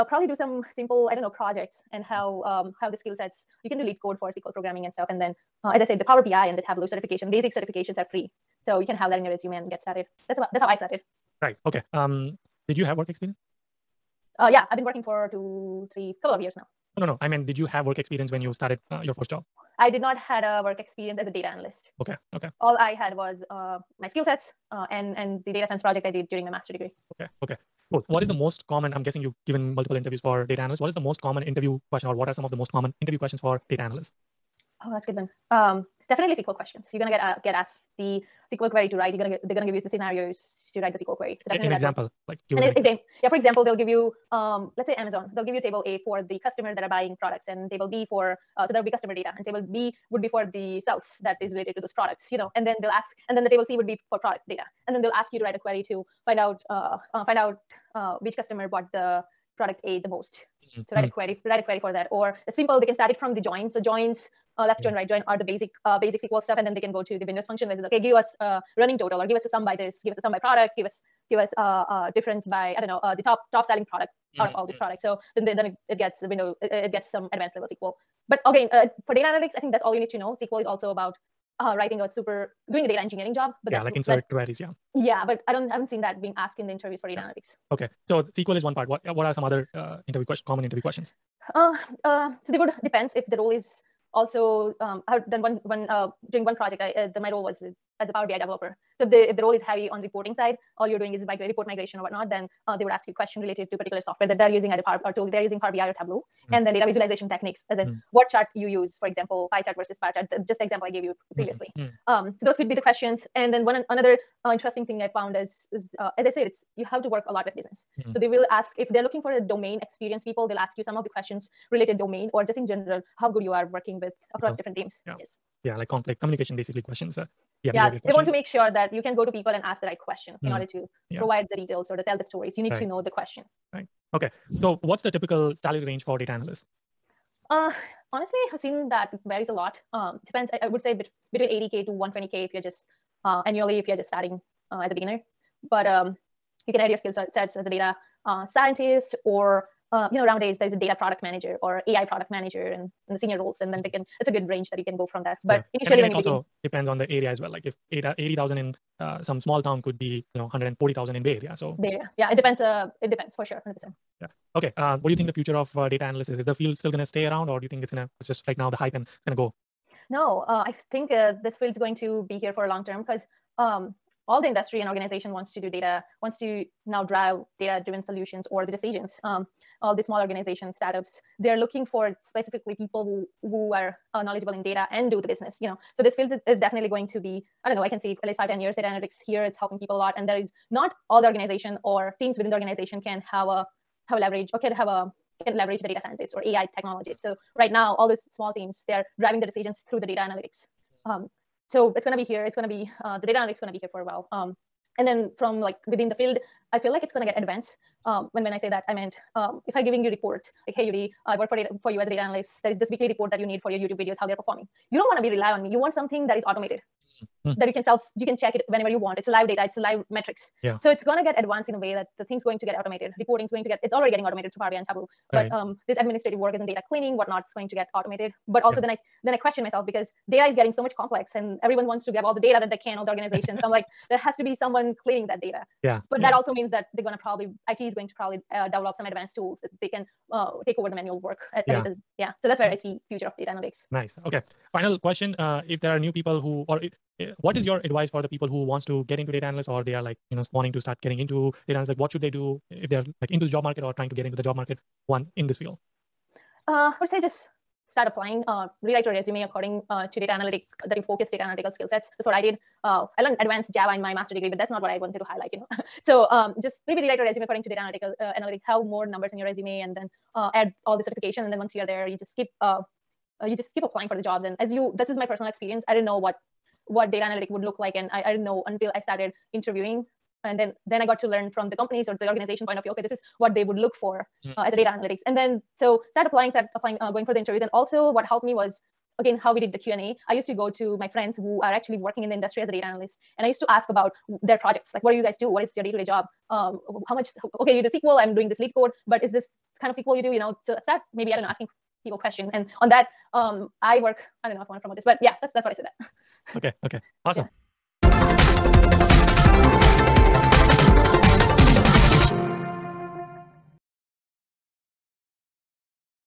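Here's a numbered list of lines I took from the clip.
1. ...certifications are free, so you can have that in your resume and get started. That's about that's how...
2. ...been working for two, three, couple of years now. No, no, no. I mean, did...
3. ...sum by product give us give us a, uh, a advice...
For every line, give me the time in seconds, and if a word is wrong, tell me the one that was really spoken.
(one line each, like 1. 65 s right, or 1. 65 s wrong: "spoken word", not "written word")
1. 7 s right
2. 14 s right
3. 70 s wrong: "difference", not "advice".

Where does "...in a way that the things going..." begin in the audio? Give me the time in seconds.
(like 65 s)
221 s.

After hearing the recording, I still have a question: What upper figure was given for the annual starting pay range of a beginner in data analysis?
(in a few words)
120k.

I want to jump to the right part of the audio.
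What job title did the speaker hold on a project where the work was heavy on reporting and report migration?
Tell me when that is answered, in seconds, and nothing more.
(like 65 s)
98 s.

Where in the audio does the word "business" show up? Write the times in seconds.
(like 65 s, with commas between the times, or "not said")
117 s, 185 s.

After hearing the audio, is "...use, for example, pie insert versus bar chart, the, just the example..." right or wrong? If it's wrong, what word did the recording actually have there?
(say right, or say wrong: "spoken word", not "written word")
wrong: "chart", not "insert".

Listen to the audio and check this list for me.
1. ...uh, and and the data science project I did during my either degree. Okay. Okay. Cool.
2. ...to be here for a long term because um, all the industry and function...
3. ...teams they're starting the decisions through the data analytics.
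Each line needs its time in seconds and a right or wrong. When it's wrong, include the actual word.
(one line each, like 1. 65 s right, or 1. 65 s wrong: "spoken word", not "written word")
1. 24 s wrong: "master", not "either"
2. 172 s wrong: "organization", not "function"
3. 198 s wrong: "driving", not "starting".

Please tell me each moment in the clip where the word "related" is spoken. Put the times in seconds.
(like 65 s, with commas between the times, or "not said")
51 s, 103 s, 121 s.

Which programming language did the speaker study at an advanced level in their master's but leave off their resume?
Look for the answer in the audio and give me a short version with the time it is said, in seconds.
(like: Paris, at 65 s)
Java, at 263 s.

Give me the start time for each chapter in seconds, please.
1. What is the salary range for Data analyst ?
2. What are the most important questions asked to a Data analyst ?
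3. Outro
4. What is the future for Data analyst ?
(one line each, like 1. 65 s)
1. 134 s
2. 27 s
3. 306 s
4. 164 s.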